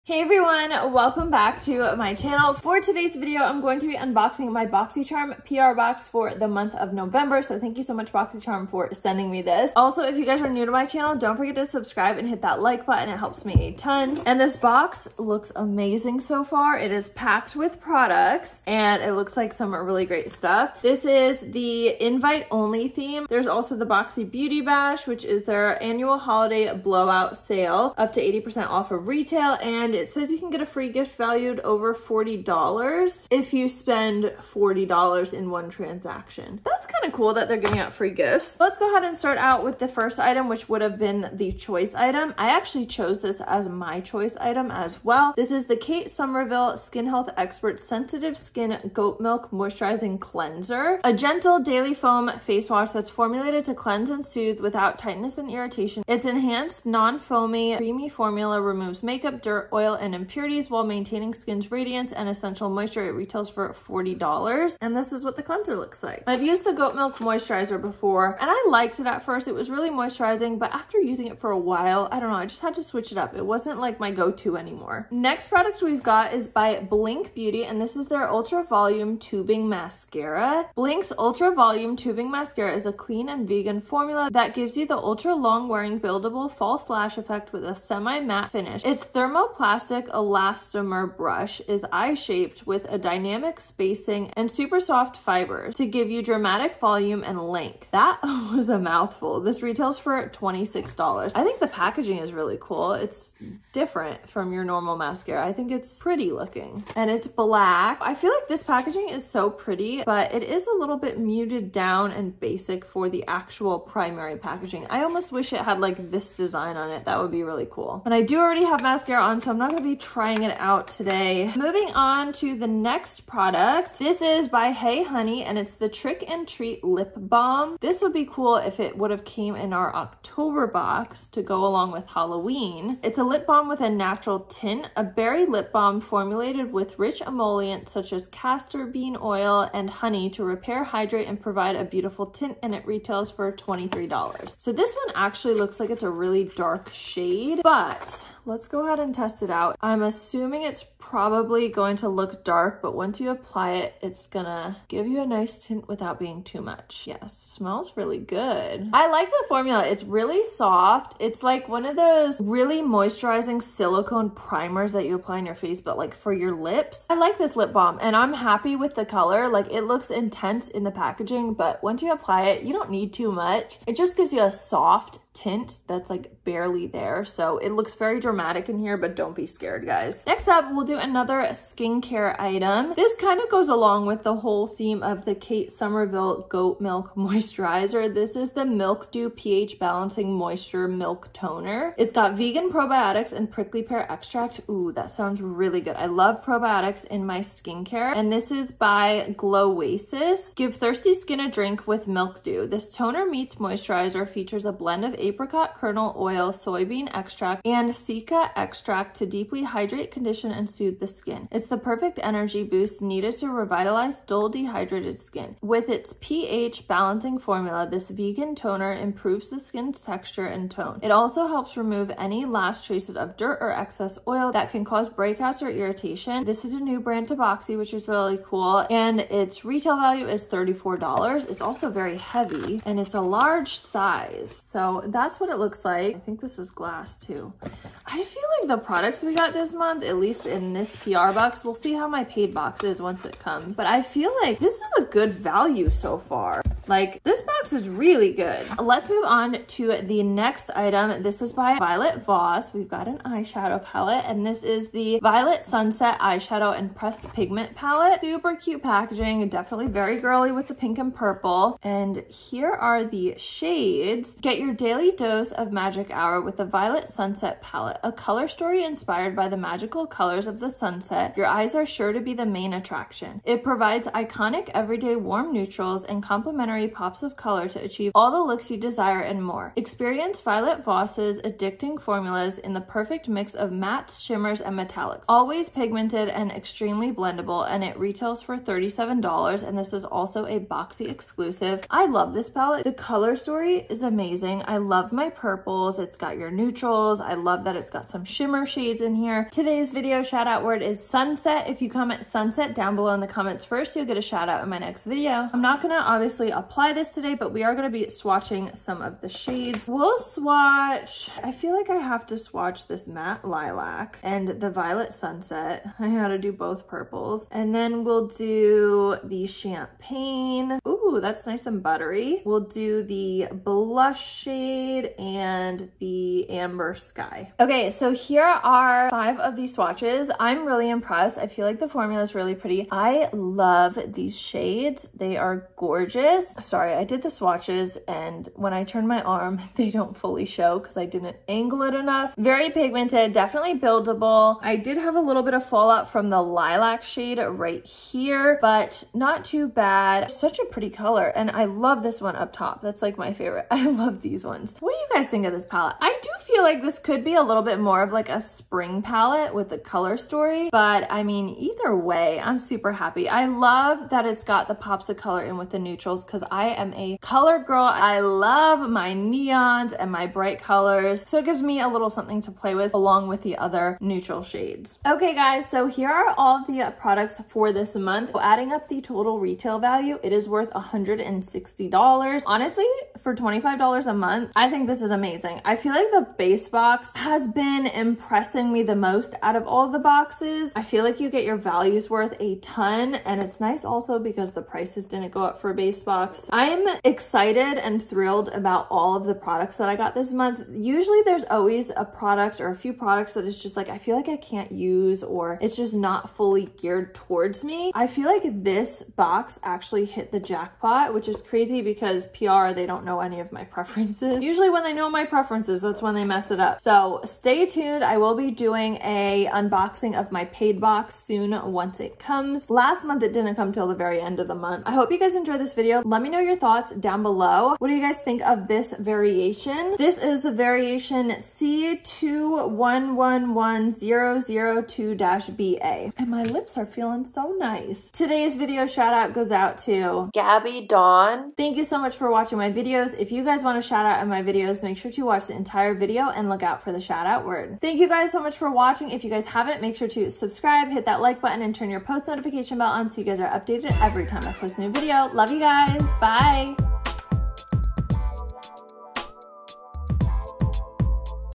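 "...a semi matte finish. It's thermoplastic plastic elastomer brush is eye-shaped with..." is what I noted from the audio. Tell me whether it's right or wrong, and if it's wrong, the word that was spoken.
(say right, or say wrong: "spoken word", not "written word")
right.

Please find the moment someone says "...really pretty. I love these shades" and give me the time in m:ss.
5:32.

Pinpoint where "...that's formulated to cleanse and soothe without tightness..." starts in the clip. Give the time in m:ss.
0:52.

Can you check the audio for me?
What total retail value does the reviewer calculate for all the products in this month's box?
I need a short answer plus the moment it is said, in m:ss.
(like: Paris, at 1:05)
$160, at 6:20.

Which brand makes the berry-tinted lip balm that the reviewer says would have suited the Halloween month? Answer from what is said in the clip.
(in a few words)
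Hey Honey.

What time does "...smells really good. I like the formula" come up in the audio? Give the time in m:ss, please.
2:37.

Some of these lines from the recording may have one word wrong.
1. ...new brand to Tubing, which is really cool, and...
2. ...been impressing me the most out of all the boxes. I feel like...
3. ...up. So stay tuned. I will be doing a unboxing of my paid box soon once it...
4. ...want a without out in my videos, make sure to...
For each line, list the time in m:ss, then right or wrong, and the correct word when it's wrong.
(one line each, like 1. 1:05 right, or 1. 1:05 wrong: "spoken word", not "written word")
1. 3:46 wrong: "Boxy", not "Tubing"
2. 6:27 right
3. 6:56 right
4. 7:23 wrong: "shout", not "without".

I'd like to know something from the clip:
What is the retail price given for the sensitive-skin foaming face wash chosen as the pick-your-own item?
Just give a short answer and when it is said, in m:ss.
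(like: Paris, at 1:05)
$40, at 1:03.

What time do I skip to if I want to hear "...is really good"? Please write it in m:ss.
4:07.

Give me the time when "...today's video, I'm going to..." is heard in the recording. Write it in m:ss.
0:02.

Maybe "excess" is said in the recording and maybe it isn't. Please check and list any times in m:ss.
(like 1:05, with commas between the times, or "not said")
3:43.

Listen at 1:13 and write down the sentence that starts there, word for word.
It wasn't like my go-to anymore.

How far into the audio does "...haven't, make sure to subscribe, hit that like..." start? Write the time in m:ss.
7:29.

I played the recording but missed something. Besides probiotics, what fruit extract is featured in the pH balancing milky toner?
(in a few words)
prickly pear.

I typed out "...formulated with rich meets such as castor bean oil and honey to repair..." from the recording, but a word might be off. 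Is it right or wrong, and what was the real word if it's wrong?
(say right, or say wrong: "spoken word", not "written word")
wrong: "emollients", not "meets".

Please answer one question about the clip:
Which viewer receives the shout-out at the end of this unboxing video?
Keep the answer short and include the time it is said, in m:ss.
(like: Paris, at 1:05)
Gabby Dawn, at 7:20.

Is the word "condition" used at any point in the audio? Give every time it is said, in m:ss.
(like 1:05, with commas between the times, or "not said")
3:30.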